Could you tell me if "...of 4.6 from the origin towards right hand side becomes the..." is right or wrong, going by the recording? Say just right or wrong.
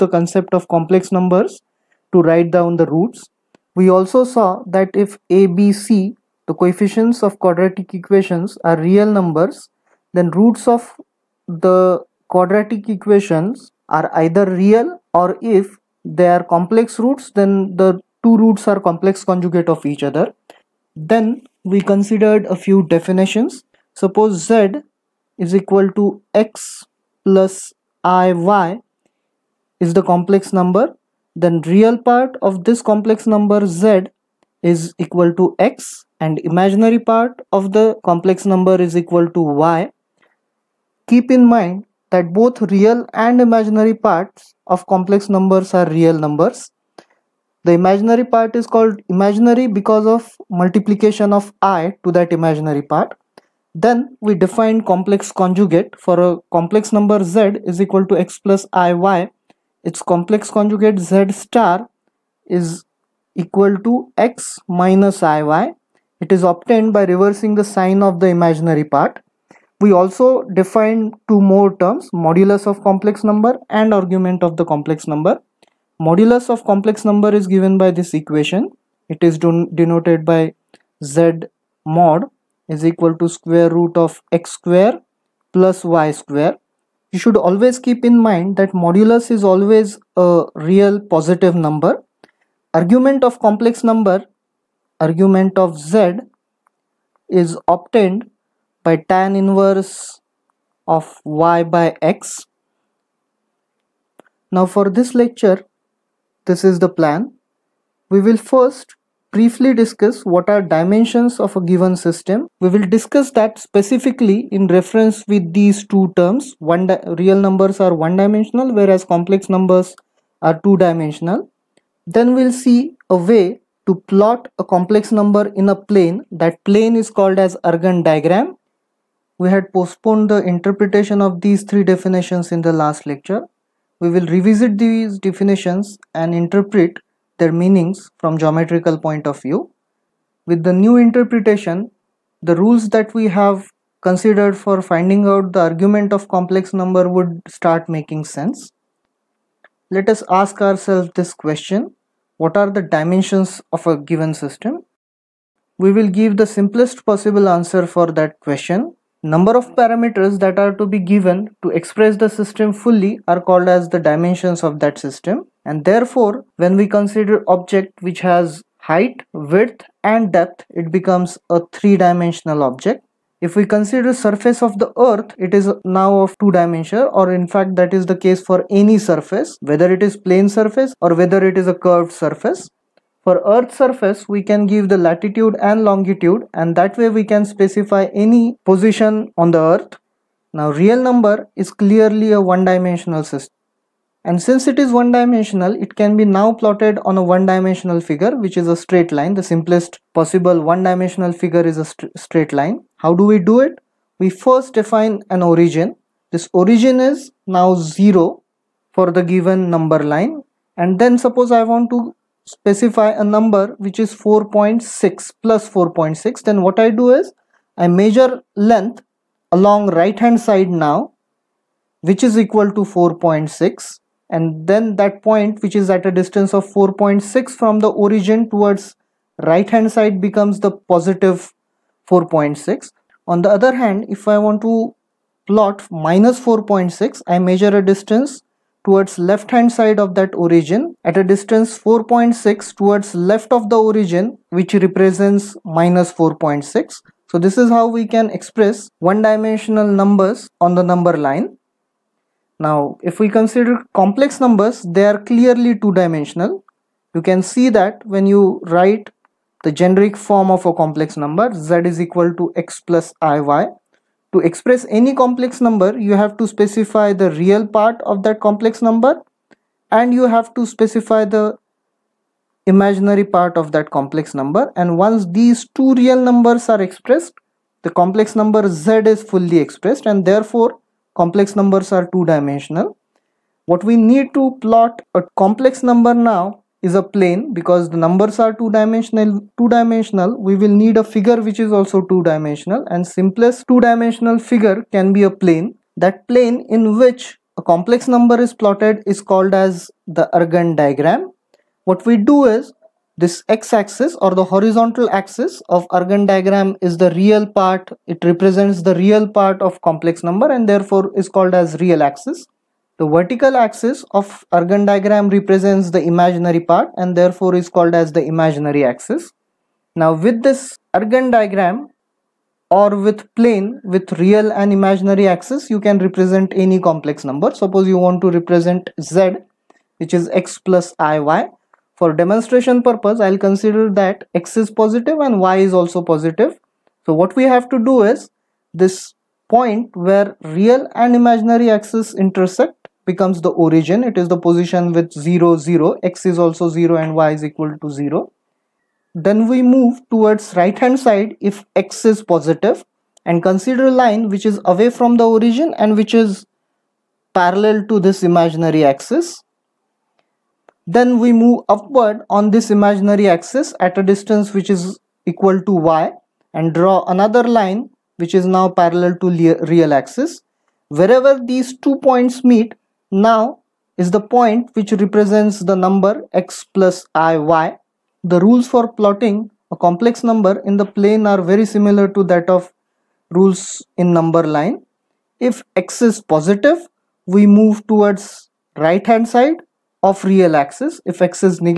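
right.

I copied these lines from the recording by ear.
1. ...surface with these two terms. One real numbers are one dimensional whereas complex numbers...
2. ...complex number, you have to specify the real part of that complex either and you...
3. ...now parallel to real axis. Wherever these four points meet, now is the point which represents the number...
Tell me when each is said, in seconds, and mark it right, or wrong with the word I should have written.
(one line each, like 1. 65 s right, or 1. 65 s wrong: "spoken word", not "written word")
1. 114 s wrong: "reference", not "surface"
2. 265 s wrong: "number", not "either"
3. 368 s wrong: "two", not "four".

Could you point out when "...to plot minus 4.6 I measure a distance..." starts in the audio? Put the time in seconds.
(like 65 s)
234 s.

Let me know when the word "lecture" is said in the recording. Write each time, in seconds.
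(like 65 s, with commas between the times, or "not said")
105 s, 133 s.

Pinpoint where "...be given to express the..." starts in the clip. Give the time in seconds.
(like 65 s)
160 s.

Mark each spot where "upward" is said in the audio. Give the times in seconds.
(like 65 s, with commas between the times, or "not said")
361 s.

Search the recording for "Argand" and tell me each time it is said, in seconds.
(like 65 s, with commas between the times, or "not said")
127 s, 300 s, 305 s, 314 s, 320 s.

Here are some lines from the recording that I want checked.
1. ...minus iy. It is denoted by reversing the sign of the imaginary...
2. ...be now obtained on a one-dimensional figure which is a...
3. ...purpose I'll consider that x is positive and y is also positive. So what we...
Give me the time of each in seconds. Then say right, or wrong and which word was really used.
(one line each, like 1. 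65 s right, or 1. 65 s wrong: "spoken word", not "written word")
1. 64 s wrong: "obtained", not "denoted"
2. 196 s wrong: "plotted", not "obtained"
3. 332 s right.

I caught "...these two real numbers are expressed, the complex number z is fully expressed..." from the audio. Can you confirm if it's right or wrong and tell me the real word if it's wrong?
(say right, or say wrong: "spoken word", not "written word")
right.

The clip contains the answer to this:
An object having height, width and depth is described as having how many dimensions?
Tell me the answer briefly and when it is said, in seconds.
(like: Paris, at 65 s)
3, at 171 s.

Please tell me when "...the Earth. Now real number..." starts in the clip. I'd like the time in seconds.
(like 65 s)
189 s.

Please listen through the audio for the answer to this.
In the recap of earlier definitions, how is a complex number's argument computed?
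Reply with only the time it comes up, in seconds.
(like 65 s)
99 s.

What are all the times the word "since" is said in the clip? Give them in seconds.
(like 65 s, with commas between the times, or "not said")
194 s.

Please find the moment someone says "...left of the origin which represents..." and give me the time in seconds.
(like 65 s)
243 s.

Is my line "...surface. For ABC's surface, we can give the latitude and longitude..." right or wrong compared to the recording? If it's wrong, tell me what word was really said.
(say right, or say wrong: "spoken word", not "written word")
wrong: "Earth", not "ABC".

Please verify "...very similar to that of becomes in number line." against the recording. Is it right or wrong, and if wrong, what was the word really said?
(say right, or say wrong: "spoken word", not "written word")
wrong: "rules", not "becomes".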